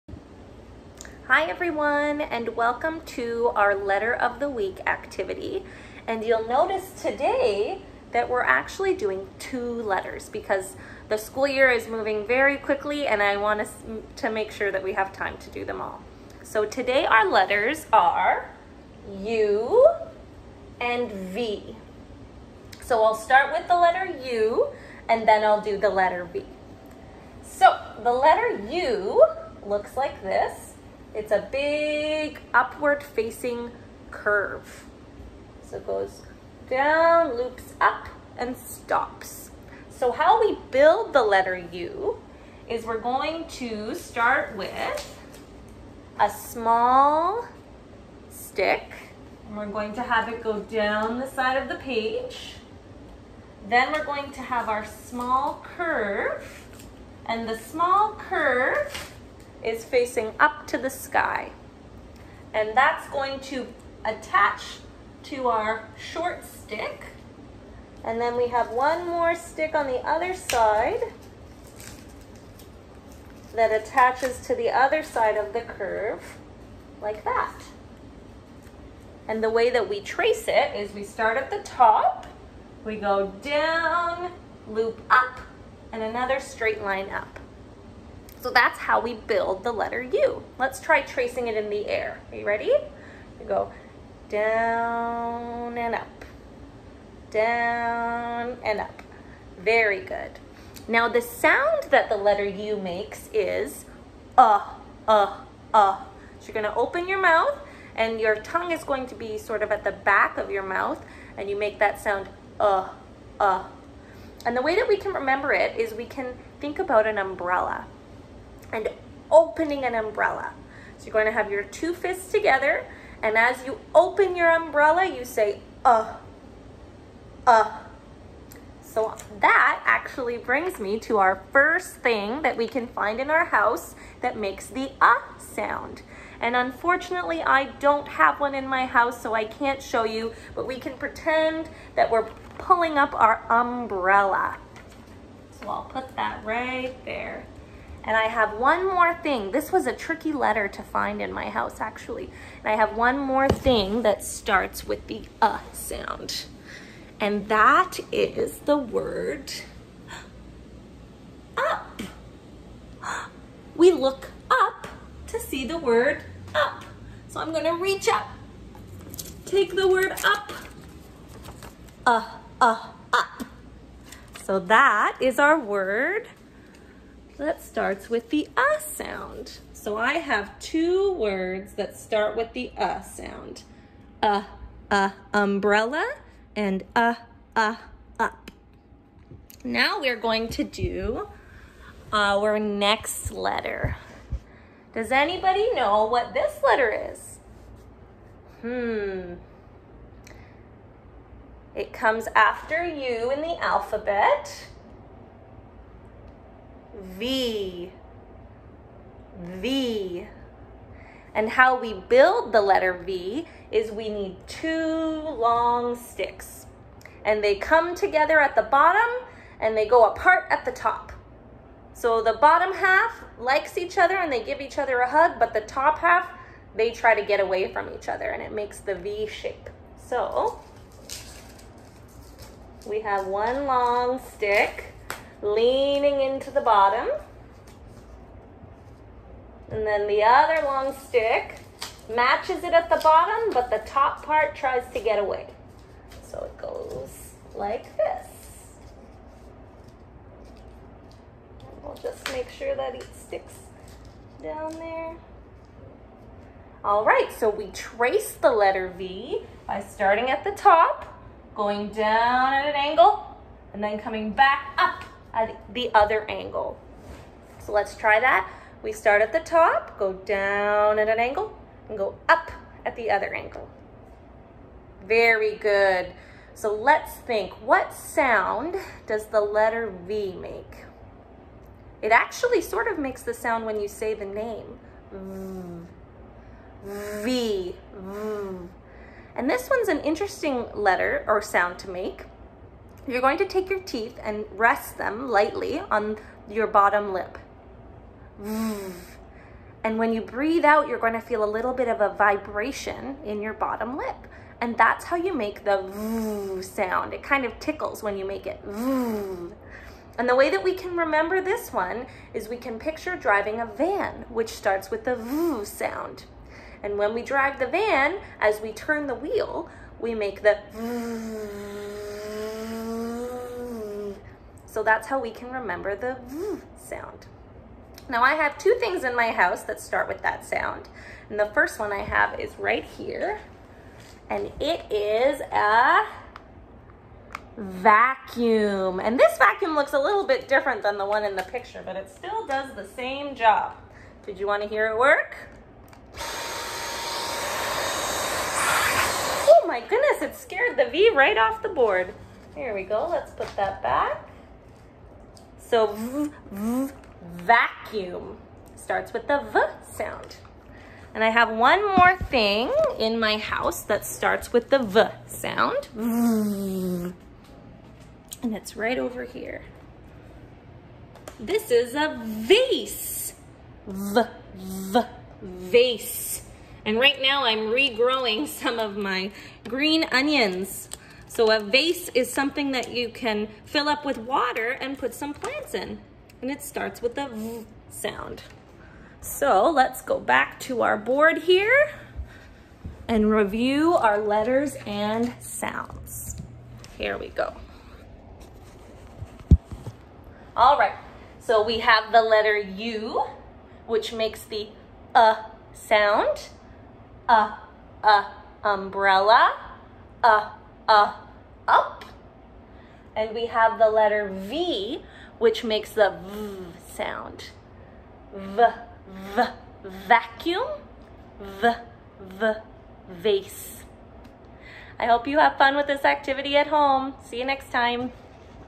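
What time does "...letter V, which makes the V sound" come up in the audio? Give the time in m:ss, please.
6:53.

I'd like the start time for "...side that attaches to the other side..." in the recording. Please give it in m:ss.
1:10.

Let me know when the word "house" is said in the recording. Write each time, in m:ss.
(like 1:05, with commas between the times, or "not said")
2:13, 2:18, 2:31, 5:29, 6:03.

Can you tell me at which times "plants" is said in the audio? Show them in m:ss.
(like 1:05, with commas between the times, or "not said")
6:25.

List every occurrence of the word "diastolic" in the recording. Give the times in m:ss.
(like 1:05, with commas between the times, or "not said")
not said.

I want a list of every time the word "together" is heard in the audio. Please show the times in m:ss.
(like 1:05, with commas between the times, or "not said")
2:02, 3:37.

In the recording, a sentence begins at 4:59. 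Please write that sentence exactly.
And when you breathe out, you're going to feel a little bit of a vibration in your bottom lip.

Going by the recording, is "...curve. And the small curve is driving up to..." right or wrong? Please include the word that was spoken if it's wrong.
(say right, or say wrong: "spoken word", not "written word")
wrong: "facing", not "driving".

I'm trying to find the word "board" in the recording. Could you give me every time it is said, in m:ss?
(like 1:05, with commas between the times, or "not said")
5:51, 6:30.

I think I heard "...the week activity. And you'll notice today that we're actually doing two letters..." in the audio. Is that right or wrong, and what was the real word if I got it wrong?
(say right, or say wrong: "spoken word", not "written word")
right.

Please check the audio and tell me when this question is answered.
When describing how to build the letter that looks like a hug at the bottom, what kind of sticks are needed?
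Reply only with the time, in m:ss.
3:34.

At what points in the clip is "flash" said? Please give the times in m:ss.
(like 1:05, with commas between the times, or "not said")
not said.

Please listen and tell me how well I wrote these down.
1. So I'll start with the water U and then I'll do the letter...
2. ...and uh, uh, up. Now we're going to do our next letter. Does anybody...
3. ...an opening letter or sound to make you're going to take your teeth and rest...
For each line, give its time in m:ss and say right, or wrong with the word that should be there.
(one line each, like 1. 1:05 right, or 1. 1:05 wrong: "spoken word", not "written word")
1. 0:22 wrong: "letter", not "water"
2. 3:06 right
3. 4:49 wrong: "interesting", not "opening".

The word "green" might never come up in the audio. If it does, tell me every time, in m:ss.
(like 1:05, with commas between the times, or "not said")
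6:19.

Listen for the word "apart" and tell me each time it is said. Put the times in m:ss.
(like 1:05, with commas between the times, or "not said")
3:40.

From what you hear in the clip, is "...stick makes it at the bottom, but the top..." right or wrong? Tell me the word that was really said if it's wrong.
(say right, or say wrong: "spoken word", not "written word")
wrong: "matches", not "makes".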